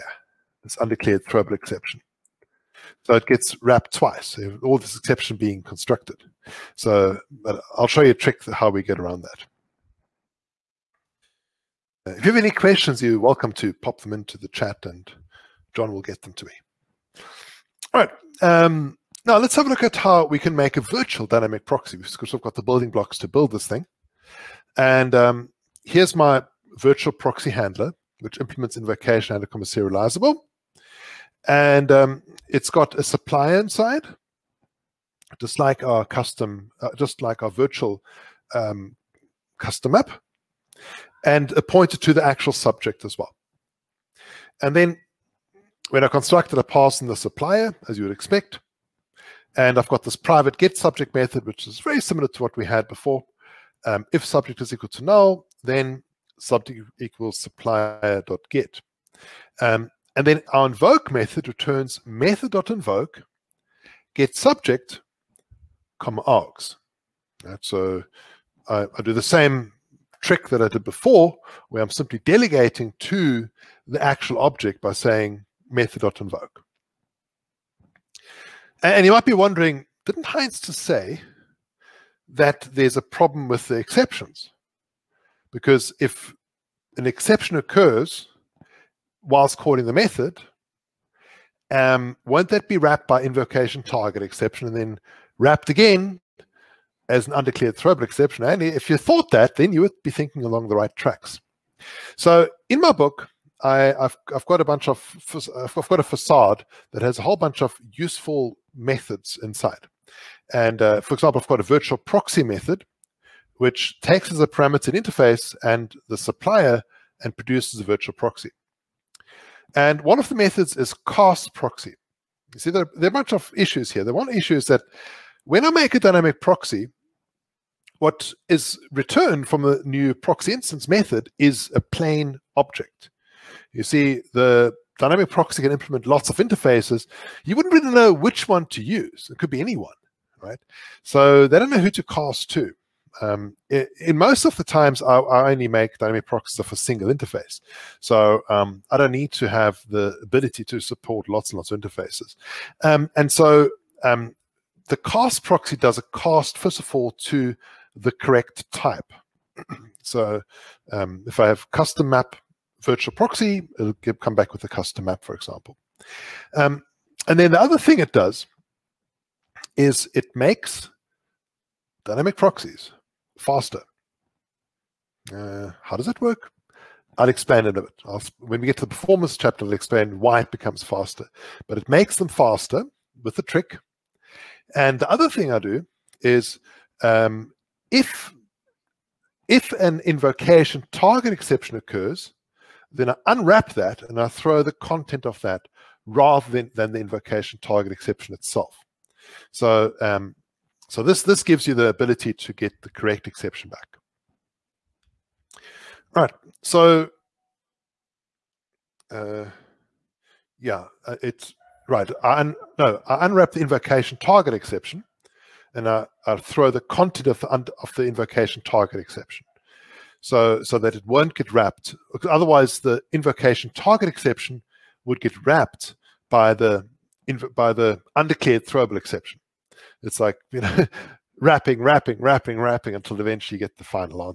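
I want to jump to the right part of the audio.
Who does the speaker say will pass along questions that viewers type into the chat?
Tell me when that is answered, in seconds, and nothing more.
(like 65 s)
15 s.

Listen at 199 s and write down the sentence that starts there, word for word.
So um, so this, this gives you the ability to get the correct exception back.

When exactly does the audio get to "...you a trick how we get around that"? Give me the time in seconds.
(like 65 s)
8 s.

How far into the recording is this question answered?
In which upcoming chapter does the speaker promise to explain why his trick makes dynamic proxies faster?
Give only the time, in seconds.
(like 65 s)
178 s.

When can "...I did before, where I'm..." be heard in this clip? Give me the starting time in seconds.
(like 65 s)
70 s.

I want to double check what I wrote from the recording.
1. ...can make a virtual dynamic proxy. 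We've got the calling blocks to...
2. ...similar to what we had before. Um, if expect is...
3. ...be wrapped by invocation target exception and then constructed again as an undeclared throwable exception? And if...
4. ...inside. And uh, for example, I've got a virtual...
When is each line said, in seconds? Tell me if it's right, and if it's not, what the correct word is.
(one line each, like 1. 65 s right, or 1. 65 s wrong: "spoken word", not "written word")
1. 20 s wrong: "building", not "calling"
2. 52 s wrong: "subject", not "expect"
3. 92 s wrong: "wrapped", not "constructed"
4. 109 s right.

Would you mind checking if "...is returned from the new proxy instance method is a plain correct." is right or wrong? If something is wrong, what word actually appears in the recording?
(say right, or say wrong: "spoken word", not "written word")
wrong: "object", not "correct".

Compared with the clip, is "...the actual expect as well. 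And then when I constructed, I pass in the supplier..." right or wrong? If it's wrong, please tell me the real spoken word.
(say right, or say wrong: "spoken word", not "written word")
wrong: "subject", not "expect".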